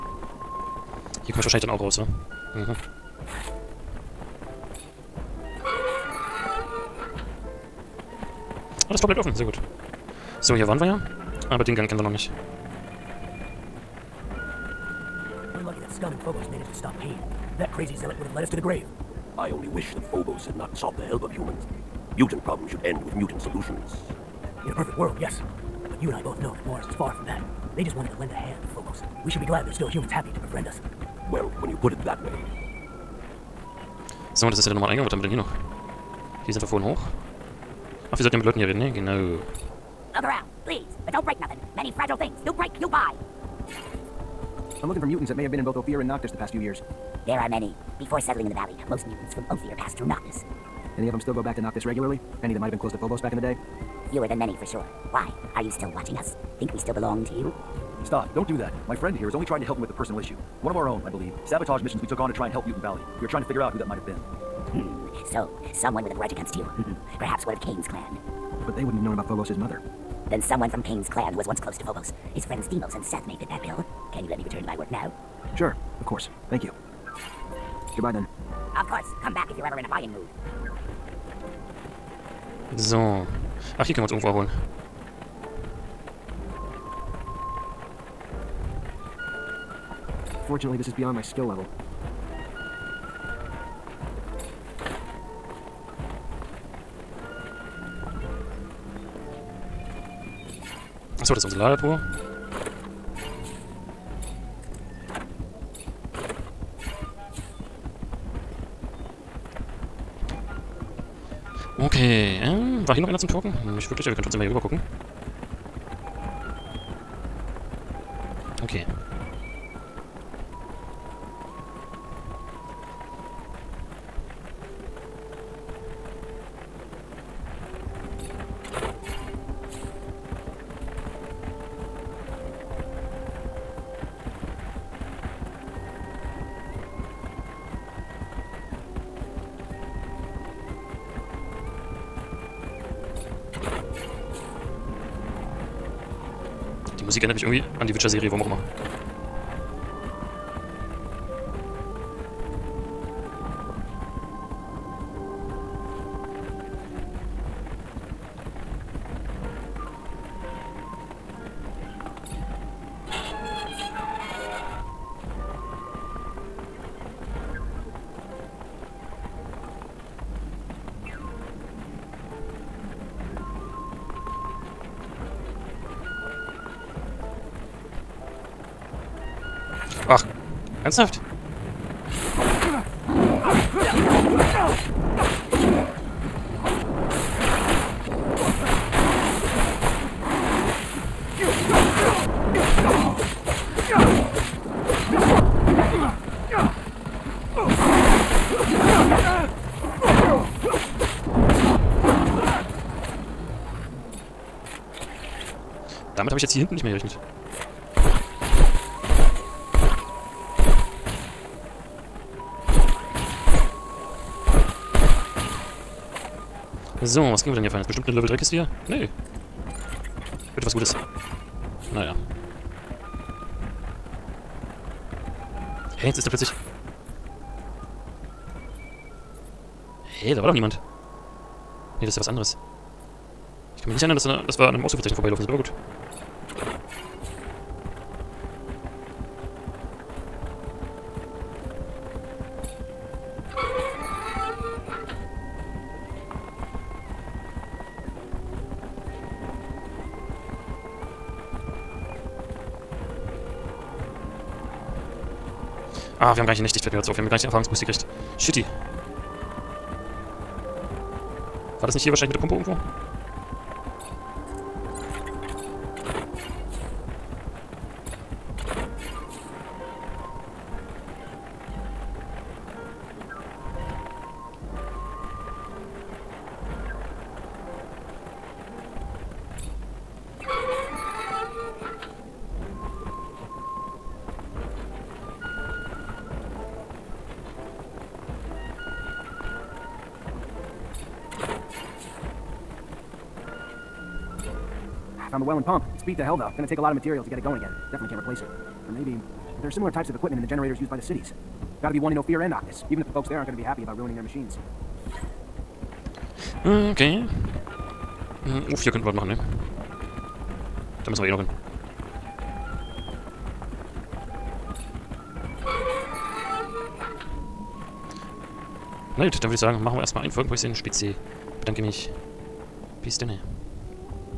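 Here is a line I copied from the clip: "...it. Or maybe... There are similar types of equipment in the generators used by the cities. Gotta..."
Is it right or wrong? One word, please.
right.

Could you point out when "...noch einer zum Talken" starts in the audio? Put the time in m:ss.
1:53.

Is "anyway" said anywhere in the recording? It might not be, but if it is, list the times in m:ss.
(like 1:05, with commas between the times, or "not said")
not said.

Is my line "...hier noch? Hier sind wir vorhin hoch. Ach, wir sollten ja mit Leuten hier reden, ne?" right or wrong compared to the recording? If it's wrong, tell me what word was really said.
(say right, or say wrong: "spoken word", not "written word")
right.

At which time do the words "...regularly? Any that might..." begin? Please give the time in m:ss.
0:51.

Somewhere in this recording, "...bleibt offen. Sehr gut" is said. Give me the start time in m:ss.
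0:09.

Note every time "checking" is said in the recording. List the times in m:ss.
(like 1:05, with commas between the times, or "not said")
not said.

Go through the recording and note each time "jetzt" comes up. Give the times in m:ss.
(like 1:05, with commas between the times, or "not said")
3:26, 3:46, 4:16.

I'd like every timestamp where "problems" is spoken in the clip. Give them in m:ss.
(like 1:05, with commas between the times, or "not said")
0:22.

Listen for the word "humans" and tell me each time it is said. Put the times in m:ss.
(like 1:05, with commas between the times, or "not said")
0:21, 0:29.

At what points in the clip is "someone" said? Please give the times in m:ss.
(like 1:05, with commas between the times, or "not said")
1:05, 1:10.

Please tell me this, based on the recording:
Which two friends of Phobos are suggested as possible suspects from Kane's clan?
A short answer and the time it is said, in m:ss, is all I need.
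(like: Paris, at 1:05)
Demos and Seth, at 1:12.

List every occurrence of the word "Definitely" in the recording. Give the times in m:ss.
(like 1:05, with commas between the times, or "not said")
4:57.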